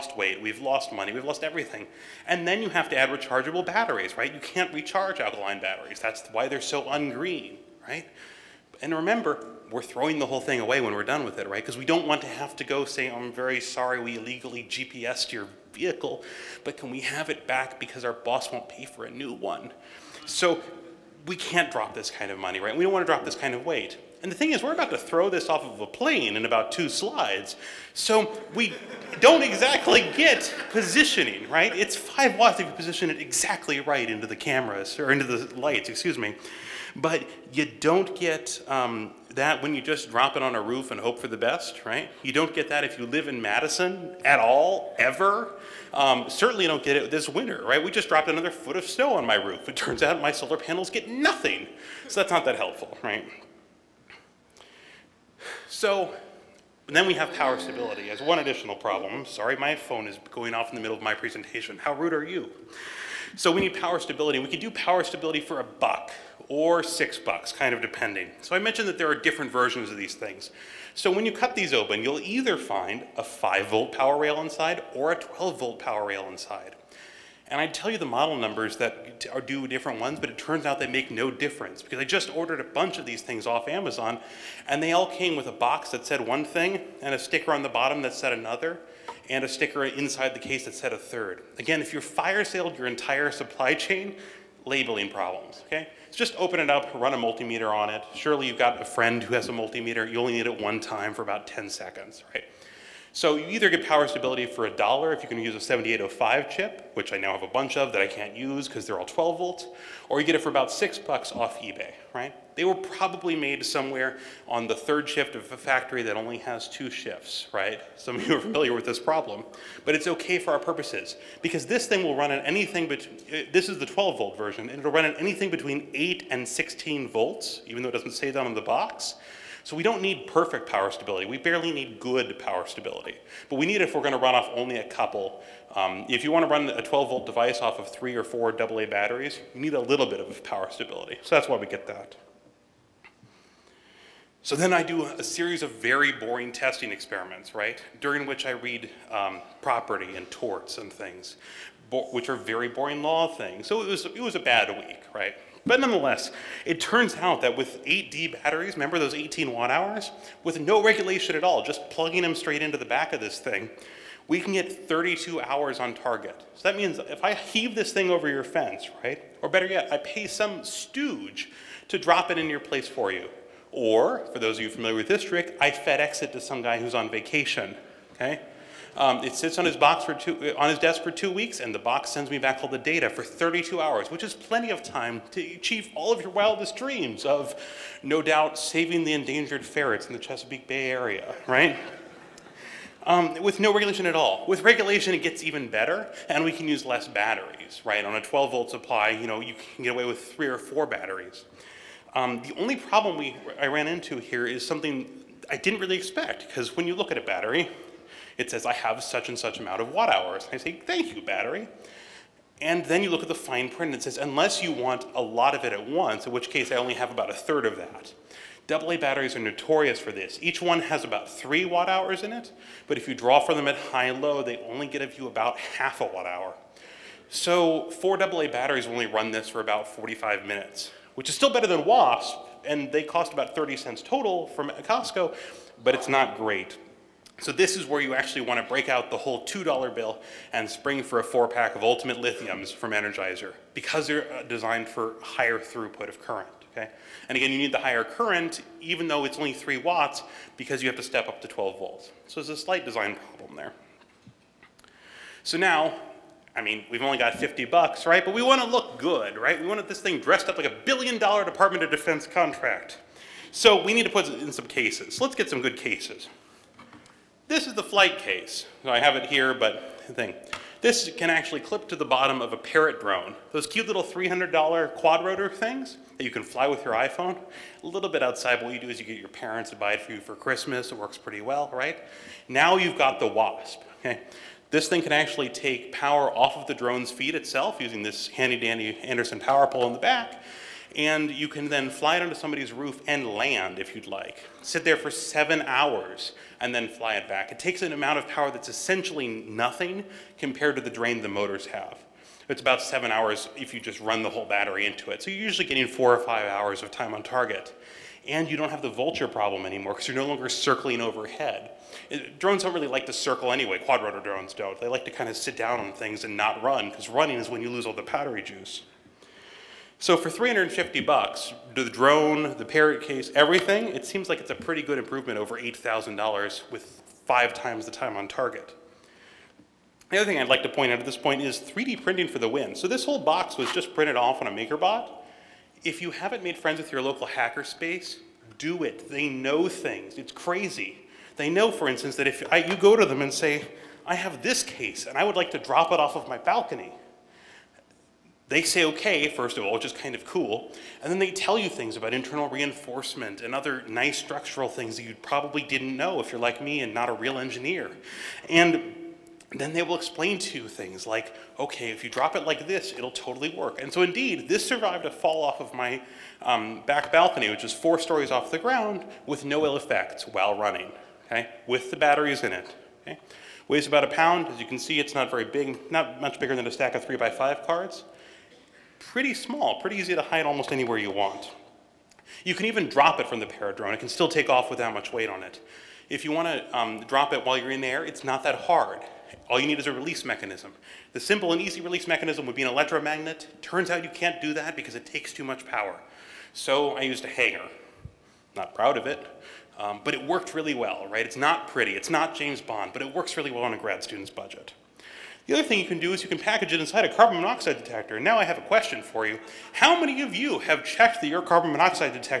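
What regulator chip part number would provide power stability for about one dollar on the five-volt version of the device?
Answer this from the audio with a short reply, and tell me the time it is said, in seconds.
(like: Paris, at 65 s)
7805, at 105 s.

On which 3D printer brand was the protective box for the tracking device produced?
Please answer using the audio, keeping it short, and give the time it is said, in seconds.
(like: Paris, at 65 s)
MakerBot, at 334 s.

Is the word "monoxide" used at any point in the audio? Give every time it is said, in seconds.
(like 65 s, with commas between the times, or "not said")
407 s, 411 s.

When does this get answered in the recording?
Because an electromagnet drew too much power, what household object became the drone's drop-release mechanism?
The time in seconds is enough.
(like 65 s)
397 s.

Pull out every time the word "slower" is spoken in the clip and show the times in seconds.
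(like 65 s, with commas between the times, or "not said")
not said.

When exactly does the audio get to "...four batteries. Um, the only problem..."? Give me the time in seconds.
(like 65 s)
200 s.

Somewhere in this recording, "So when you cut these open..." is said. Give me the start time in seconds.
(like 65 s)
70 s.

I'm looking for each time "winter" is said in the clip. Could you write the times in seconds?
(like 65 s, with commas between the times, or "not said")
47 s.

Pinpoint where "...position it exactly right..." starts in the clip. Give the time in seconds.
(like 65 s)
32 s.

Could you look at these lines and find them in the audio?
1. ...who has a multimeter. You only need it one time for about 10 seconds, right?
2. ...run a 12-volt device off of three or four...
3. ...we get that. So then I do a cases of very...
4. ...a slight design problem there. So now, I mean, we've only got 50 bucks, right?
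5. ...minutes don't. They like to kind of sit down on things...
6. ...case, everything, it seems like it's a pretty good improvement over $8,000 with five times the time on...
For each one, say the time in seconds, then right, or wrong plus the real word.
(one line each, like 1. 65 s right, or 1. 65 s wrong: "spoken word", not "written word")
1. 99 s right
2. 136 s right
3. 141 s wrong: "series", not "cases"
4. 252 s right
5. 314 s wrong: "drones", not "minutes"
6. 323 s right.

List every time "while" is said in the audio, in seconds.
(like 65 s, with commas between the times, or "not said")
370 s, 387 s.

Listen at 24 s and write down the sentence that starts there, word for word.
And the thing is, we're about to throw this off of a plane in about two slides.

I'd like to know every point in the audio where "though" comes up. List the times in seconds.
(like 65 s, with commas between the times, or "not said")
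127 s, 249 s.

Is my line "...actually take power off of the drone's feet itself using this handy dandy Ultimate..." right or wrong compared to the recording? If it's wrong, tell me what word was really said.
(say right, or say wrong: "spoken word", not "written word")
wrong: "Anderson", not "Ultimate".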